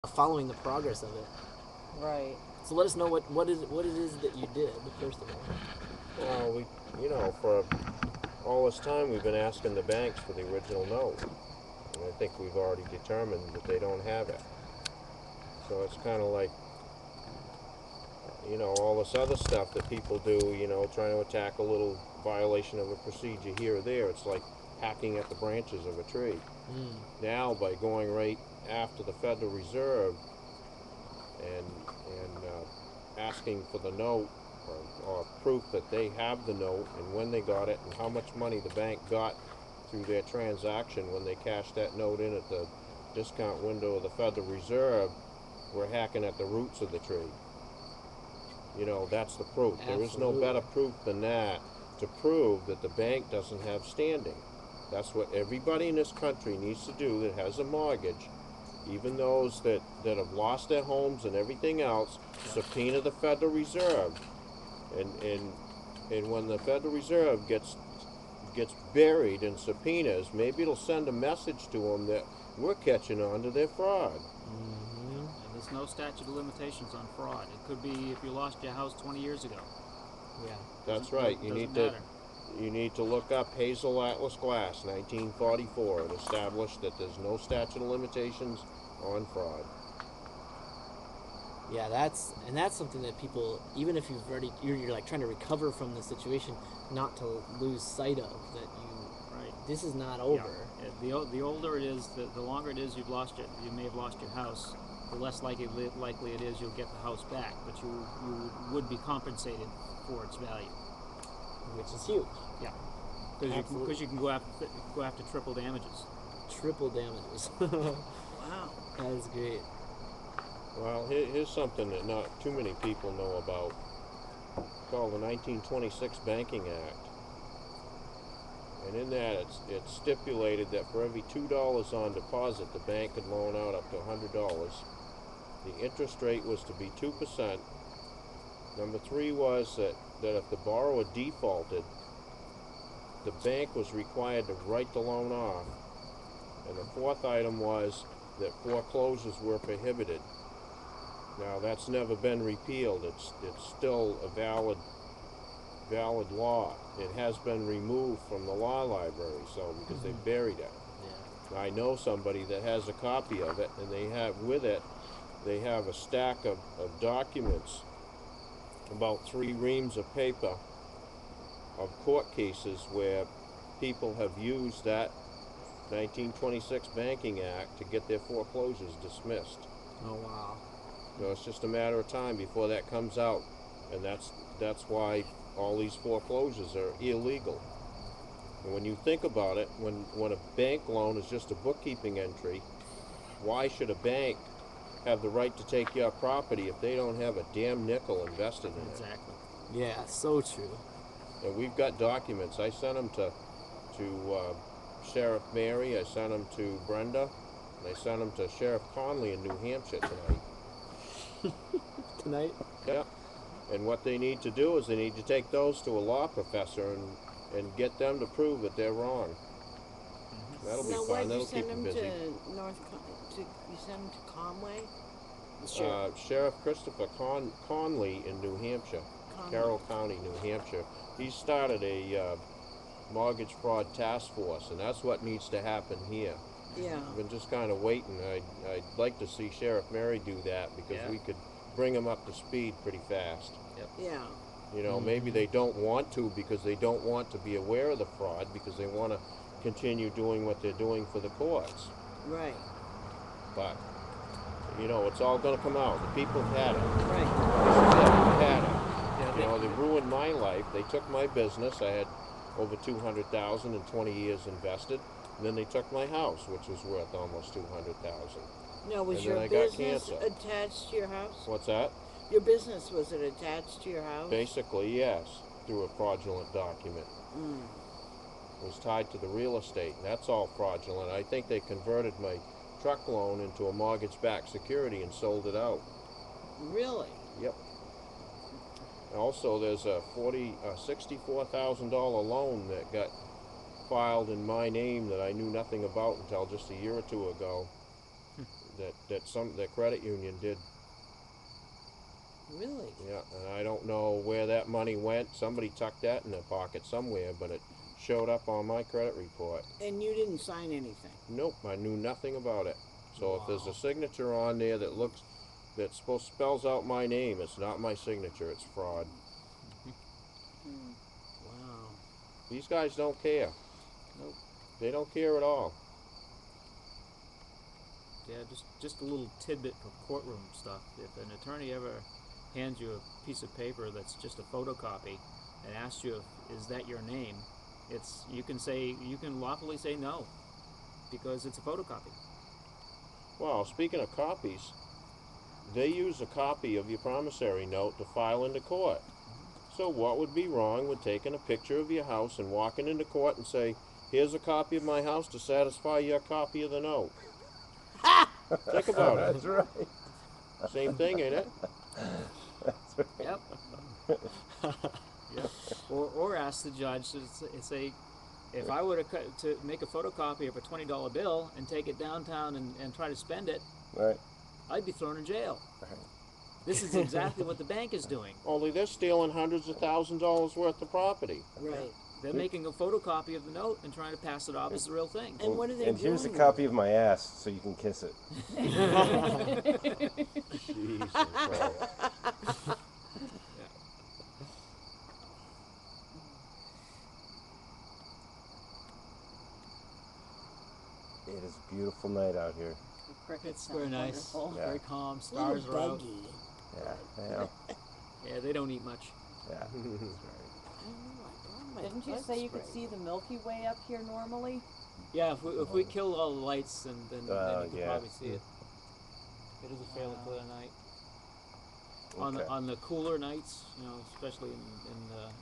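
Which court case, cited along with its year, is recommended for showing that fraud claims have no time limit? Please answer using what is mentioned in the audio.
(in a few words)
Hazel Atlas Glass.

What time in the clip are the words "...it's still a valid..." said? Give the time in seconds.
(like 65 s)
153 s.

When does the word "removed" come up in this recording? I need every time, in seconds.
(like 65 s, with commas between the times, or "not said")
157 s.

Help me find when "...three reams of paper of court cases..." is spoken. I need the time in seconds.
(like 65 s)
169 s.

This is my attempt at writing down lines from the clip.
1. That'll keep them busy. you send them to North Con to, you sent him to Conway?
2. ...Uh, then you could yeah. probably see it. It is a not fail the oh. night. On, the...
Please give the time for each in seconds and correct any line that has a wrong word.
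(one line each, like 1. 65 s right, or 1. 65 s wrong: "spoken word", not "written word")
1. 221 s right
2. 417 s right.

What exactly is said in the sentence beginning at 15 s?
So it's kind of like you know all this other stuff that people do.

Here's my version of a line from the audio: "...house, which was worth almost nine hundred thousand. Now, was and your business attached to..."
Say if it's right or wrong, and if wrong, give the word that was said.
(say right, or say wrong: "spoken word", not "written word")
wrong: "two", not "nine".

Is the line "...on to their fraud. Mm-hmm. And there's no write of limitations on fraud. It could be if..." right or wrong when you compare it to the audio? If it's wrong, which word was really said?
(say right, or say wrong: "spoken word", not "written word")
wrong: "statute", not "write".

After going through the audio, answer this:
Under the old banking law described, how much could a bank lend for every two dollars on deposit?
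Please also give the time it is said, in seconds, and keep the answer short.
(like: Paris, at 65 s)
$100, at 133 s.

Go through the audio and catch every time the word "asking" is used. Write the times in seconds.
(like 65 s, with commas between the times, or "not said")
9 s, 33 s.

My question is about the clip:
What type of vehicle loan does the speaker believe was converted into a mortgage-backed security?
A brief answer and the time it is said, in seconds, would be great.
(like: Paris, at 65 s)
Truck loan, at 282 s.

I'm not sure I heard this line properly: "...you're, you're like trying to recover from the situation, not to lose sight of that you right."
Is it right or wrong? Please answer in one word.
right.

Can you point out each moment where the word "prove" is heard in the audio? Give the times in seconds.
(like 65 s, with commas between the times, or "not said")
52 s, 218 s.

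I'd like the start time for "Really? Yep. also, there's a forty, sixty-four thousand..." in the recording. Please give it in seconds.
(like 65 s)
286 s.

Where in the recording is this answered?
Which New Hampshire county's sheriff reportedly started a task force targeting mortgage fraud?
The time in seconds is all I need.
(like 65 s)
229 s.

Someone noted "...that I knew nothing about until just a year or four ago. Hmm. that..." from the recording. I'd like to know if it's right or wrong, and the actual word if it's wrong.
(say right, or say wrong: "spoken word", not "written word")
wrong: "two", not "four".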